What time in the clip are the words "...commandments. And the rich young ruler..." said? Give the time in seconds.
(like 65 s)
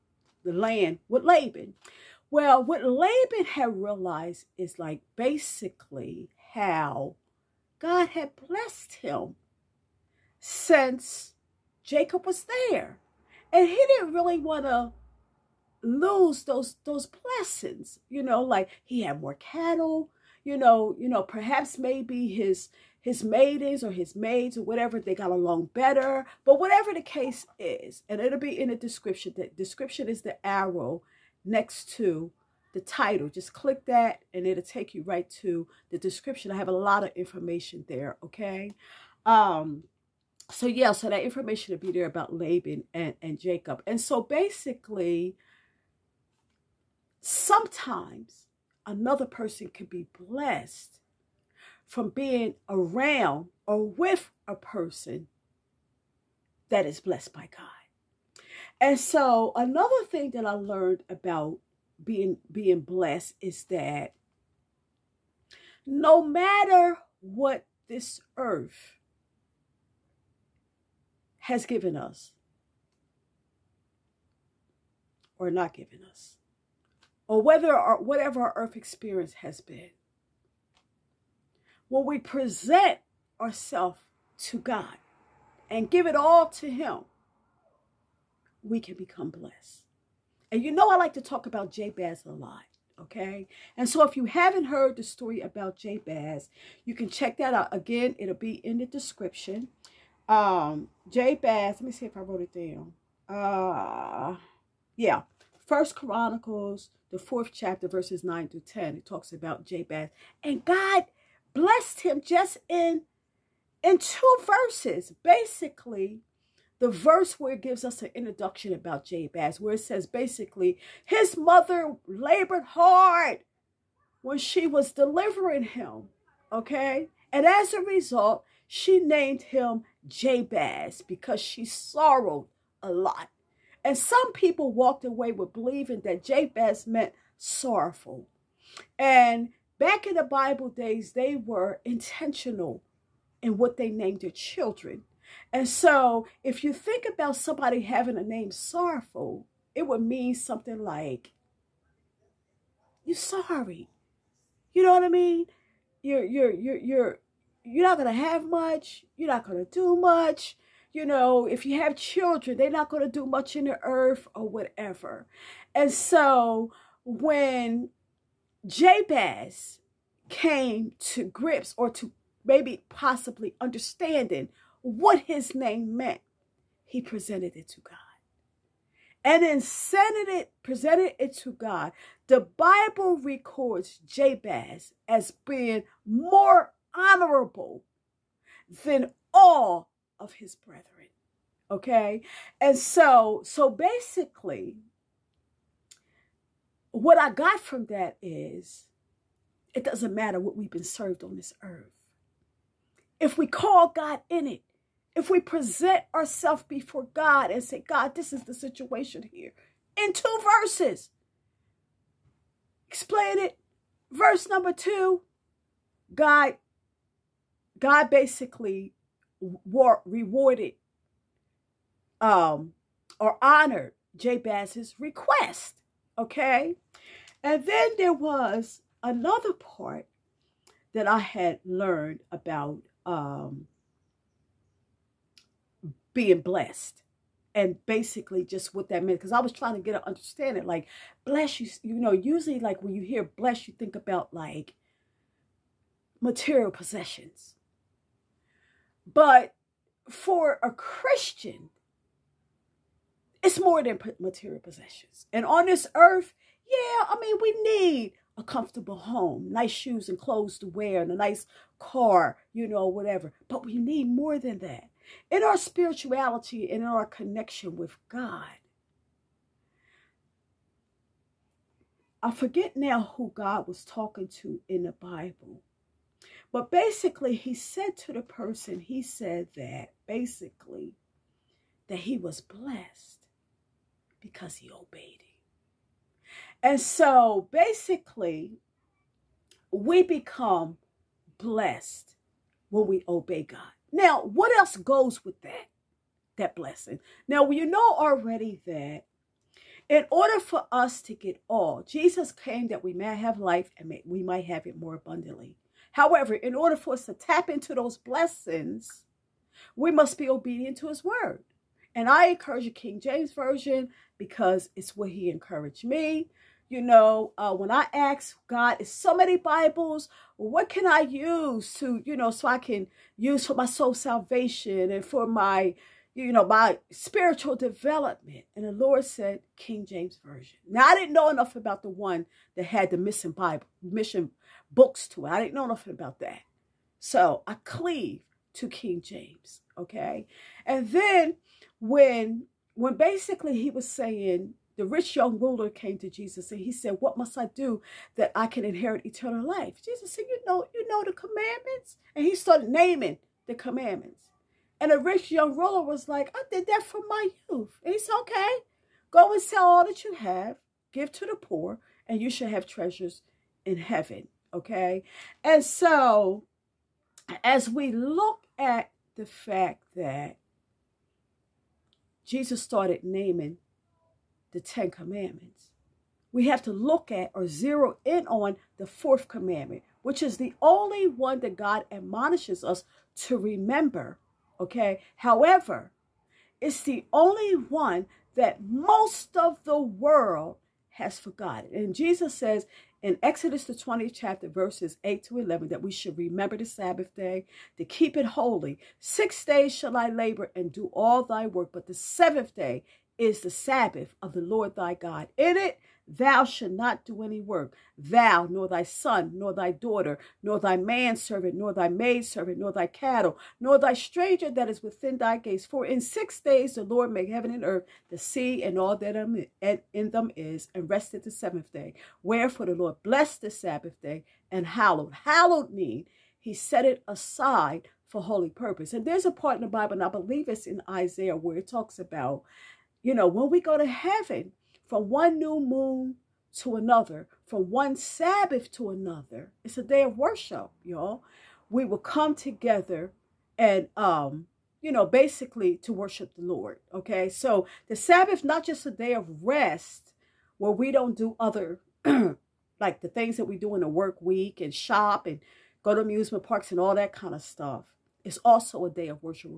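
353 s.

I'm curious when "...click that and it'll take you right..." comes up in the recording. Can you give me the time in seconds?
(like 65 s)
33 s.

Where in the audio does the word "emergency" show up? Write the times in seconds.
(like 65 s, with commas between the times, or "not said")
not said.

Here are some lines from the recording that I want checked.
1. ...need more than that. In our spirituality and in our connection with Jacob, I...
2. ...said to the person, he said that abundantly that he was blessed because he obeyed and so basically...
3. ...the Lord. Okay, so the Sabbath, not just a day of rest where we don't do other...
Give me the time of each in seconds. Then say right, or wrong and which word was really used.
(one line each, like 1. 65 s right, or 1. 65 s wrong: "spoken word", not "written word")
1. 263 s wrong: "God", not "Jacob"
2. 277 s wrong: "basically", not "abundantly"
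3. 446 s right.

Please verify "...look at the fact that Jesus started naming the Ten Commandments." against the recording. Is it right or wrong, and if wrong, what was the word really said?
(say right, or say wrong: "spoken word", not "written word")
right.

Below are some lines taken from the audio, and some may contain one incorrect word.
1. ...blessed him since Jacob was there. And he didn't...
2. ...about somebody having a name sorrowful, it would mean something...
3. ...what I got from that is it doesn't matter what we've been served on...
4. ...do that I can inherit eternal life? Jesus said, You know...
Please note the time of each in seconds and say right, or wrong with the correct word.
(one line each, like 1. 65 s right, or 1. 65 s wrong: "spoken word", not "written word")
1. 8 s right
2. 147 s right
3. 197 s right
4. 347 s right.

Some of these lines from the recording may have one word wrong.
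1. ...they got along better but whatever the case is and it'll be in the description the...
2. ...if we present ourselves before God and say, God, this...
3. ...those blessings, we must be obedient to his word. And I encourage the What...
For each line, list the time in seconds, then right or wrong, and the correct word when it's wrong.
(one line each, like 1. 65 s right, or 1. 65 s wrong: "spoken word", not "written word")
1. 24 s right
2. 205 s right
3. 307 s wrong: "King", not "What".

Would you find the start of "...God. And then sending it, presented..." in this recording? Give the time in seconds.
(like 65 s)
177 s.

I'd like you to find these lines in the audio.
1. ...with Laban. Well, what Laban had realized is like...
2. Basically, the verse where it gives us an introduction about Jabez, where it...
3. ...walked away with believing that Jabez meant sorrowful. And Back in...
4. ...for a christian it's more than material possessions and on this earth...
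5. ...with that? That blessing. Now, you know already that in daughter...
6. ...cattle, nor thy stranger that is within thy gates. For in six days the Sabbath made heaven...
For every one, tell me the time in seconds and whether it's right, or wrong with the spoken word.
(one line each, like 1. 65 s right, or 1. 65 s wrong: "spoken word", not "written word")
1. 1 s right
2. 115 s right
3. 134 s right
4. 250 s right
5. 295 s wrong: "order", not "daughter"
6. 412 s wrong: "Lord", not "Sabbath".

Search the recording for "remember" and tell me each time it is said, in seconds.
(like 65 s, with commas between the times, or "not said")
383 s, 396 s.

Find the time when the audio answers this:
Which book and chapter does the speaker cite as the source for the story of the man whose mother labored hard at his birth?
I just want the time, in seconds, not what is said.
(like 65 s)
105 s.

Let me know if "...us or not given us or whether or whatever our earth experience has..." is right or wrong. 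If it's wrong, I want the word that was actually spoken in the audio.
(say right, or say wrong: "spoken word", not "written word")
right.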